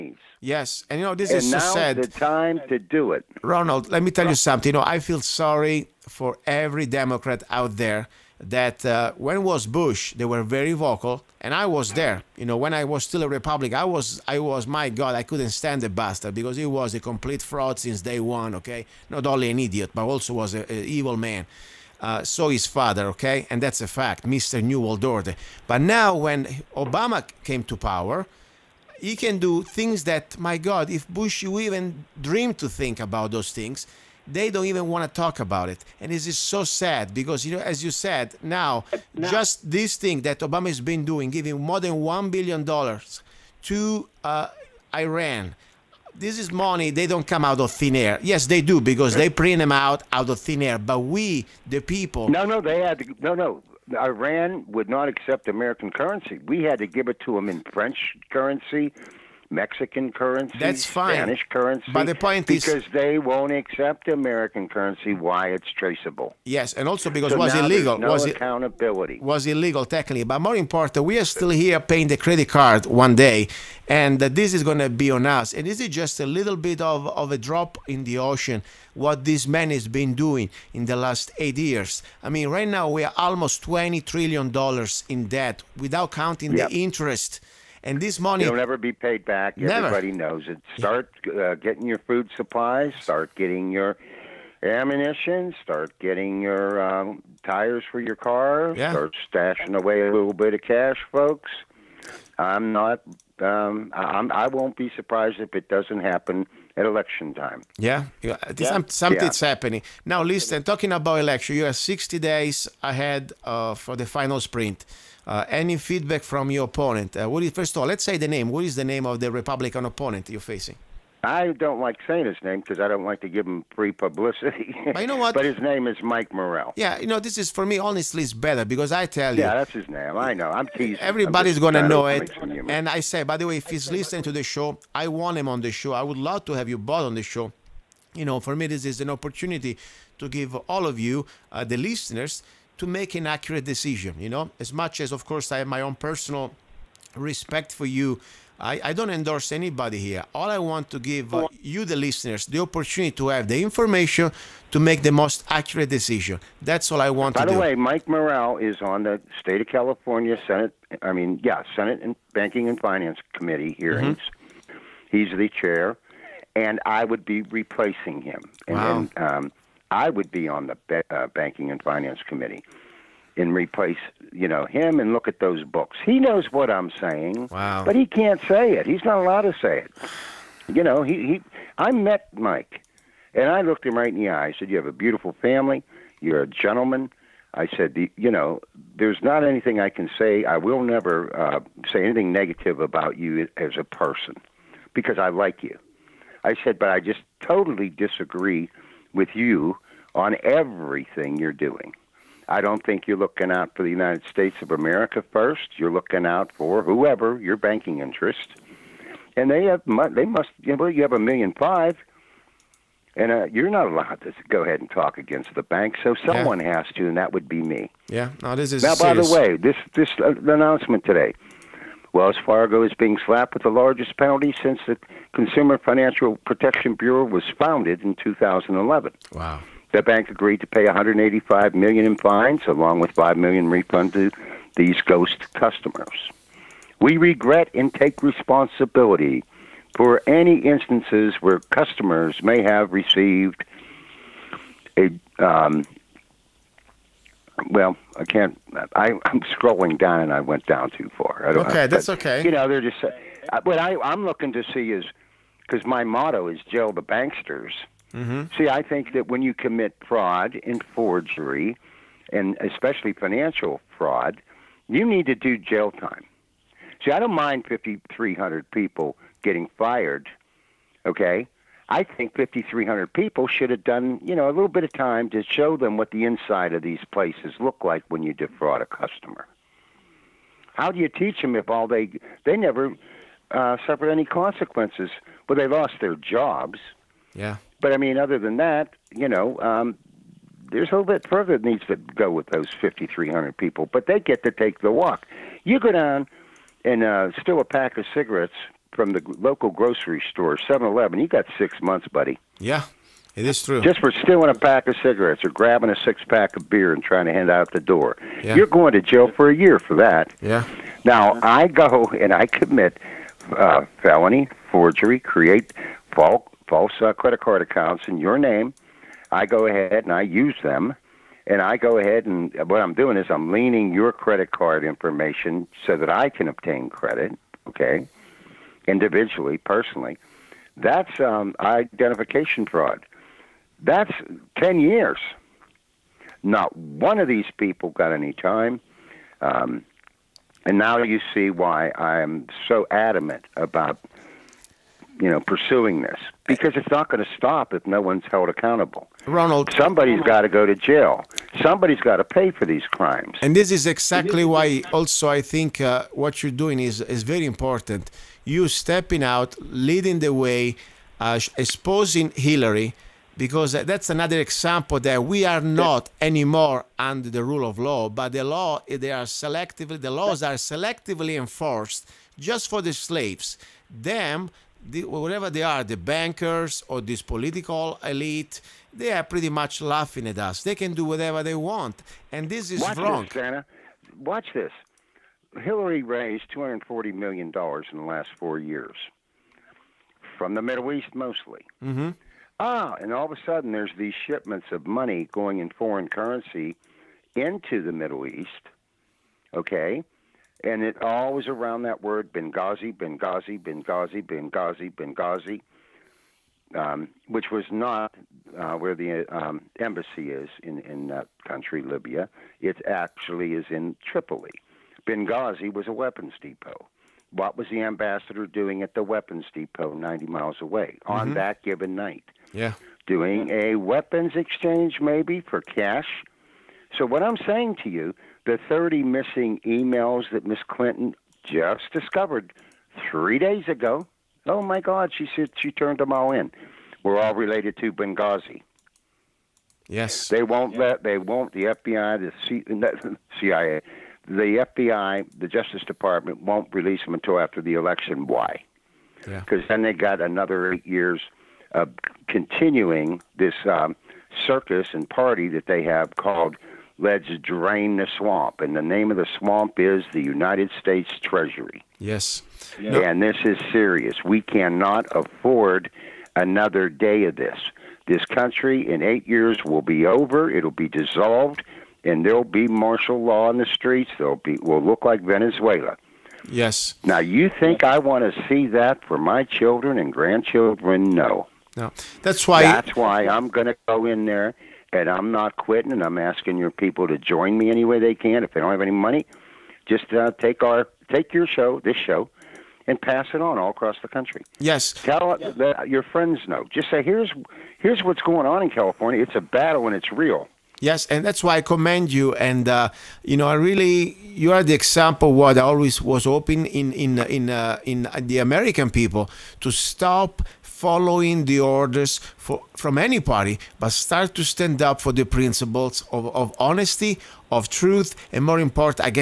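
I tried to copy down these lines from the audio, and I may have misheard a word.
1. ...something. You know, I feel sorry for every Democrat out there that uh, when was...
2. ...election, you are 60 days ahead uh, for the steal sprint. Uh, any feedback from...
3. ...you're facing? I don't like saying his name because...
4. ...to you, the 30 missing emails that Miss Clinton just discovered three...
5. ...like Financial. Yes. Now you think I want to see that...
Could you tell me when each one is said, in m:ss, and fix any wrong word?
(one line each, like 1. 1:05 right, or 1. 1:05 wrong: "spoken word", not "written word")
1. 0:04 right
2. 1:51 wrong: "final", not "steal"
3. 2:00 right
4. 7:07 right
5. 7:55 wrong: "Venezuela", not "Financial".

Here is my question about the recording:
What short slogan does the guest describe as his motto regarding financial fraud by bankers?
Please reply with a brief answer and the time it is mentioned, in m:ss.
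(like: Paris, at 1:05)
jail the banksters, at 4:16.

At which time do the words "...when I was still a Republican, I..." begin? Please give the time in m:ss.
0:12.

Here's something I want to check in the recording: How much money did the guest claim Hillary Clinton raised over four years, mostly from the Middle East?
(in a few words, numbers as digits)
$240 million.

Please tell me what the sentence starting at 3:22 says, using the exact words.
I don't think you're looking out for the United States of America first.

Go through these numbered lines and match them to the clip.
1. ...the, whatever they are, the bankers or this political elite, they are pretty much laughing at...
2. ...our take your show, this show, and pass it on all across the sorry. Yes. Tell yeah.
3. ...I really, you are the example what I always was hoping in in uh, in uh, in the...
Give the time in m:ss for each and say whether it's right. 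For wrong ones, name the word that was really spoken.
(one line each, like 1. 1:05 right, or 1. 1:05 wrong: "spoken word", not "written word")
1. 6:14 right
2. 8:10 wrong: "country", not "sorry"
3. 8:23 right.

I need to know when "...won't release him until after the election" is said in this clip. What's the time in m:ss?
7:26.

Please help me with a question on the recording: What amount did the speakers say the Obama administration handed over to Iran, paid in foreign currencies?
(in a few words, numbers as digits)
more than $1 billion.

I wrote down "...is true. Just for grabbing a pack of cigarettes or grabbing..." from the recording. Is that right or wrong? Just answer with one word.
wrong.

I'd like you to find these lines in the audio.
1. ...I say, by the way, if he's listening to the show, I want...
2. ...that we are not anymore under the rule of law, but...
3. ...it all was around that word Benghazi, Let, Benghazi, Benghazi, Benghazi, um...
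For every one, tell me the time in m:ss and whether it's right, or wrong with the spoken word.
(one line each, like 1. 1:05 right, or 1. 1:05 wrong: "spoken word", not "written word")
1. 2:12 right
2. 6:04 right
3. 6:40 wrong: "Benghazi", not "Let".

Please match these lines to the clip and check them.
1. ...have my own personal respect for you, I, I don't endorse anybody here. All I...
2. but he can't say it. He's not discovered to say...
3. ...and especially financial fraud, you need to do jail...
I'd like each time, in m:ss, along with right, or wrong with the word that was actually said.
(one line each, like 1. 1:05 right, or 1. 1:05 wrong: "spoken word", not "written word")
1. 2:25 right
2. 2:57 wrong: "allowed", not "discovered"
3. 4:22 right.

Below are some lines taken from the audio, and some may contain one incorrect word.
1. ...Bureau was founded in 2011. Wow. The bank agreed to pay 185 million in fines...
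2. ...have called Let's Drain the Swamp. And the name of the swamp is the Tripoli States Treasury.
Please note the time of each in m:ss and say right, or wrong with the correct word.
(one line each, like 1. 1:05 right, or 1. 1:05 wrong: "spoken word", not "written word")
1. 3:46 right
2. 7:35 wrong: "United", not "Tripoli".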